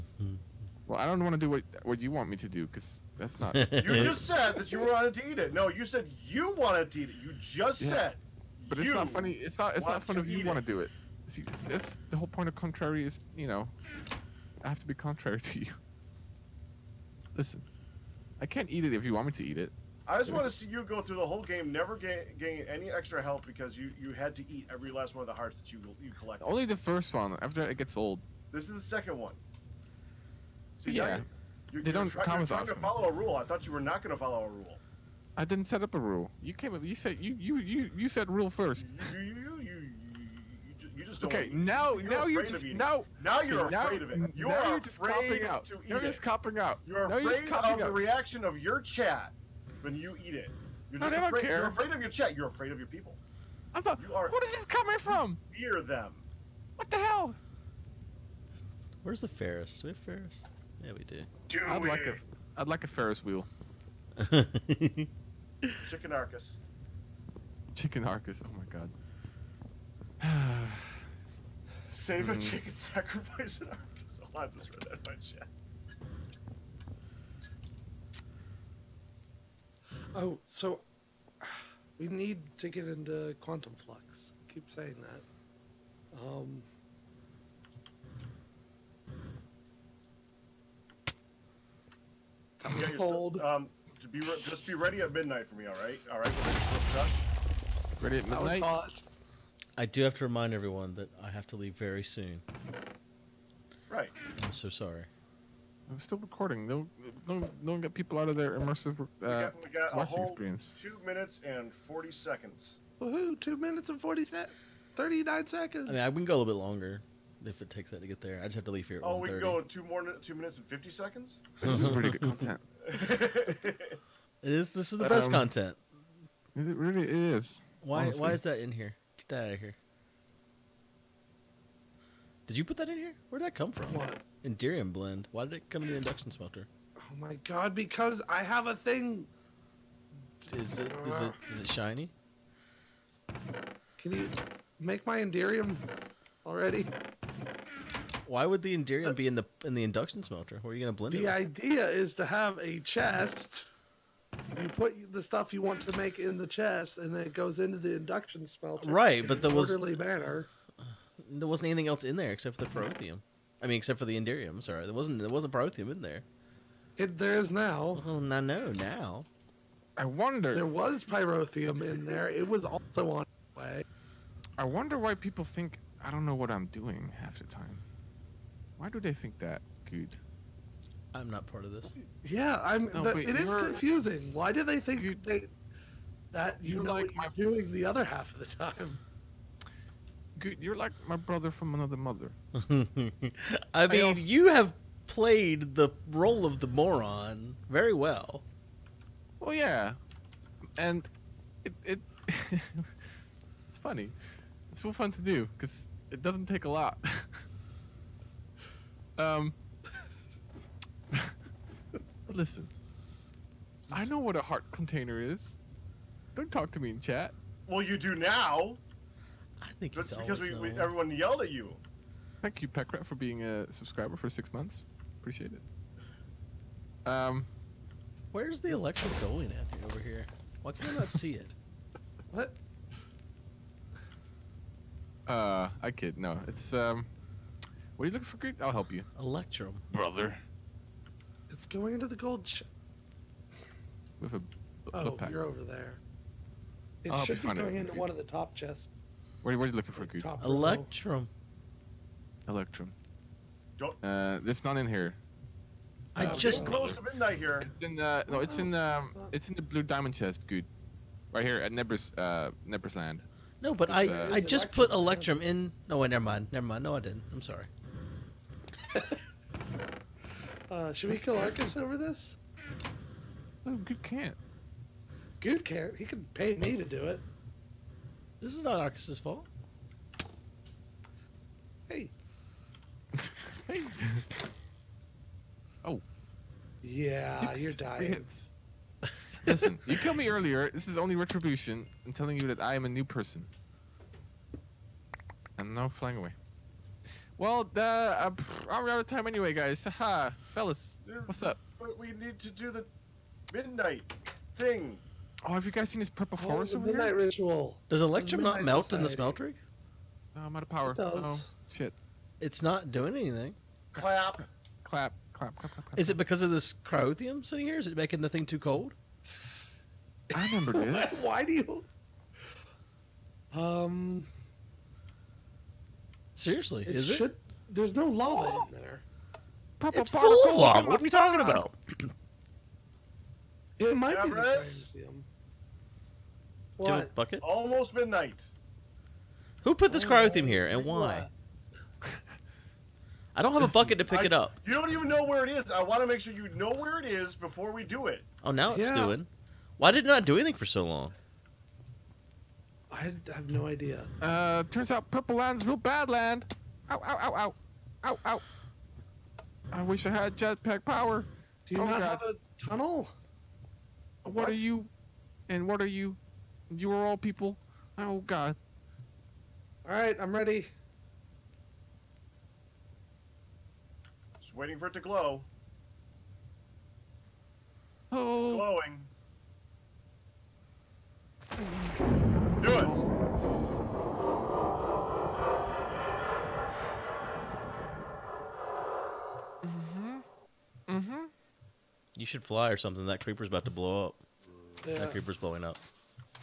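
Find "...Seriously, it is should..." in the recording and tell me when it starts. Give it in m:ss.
5:26.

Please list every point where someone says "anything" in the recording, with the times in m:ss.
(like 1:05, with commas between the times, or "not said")
2:41, 5:13, 5:50.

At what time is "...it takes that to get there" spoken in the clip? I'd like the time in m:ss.
1:57.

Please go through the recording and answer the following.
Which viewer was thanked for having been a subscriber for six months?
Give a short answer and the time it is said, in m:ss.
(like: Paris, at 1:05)
Peckrat, at 3:42.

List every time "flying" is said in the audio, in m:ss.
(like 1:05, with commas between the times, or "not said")
4:55.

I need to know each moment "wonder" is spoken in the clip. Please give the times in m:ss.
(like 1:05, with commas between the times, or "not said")
2:50, 2:54.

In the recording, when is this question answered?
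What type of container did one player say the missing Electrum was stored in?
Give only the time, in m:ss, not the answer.
4:19.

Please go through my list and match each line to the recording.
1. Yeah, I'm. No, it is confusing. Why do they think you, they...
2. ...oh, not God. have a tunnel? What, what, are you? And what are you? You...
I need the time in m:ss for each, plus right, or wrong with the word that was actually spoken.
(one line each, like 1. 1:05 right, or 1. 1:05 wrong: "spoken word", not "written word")
1. 3:02 right
2. 6:01 right.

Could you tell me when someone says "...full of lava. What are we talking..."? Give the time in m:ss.
5:30.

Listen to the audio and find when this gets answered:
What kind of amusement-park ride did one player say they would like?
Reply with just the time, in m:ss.
1:02.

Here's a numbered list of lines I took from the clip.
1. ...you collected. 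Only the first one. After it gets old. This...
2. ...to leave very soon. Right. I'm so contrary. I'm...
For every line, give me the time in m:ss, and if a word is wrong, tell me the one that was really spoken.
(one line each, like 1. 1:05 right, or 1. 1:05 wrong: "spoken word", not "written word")
1. 0:26 right
2. 1:41 wrong: "sorry", not "contrary".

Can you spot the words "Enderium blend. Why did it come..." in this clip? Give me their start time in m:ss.
2:14.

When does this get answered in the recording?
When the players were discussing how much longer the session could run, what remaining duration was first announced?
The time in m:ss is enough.
1:50.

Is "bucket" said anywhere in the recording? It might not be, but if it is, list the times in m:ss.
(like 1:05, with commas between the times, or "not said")
5:37, 5:43.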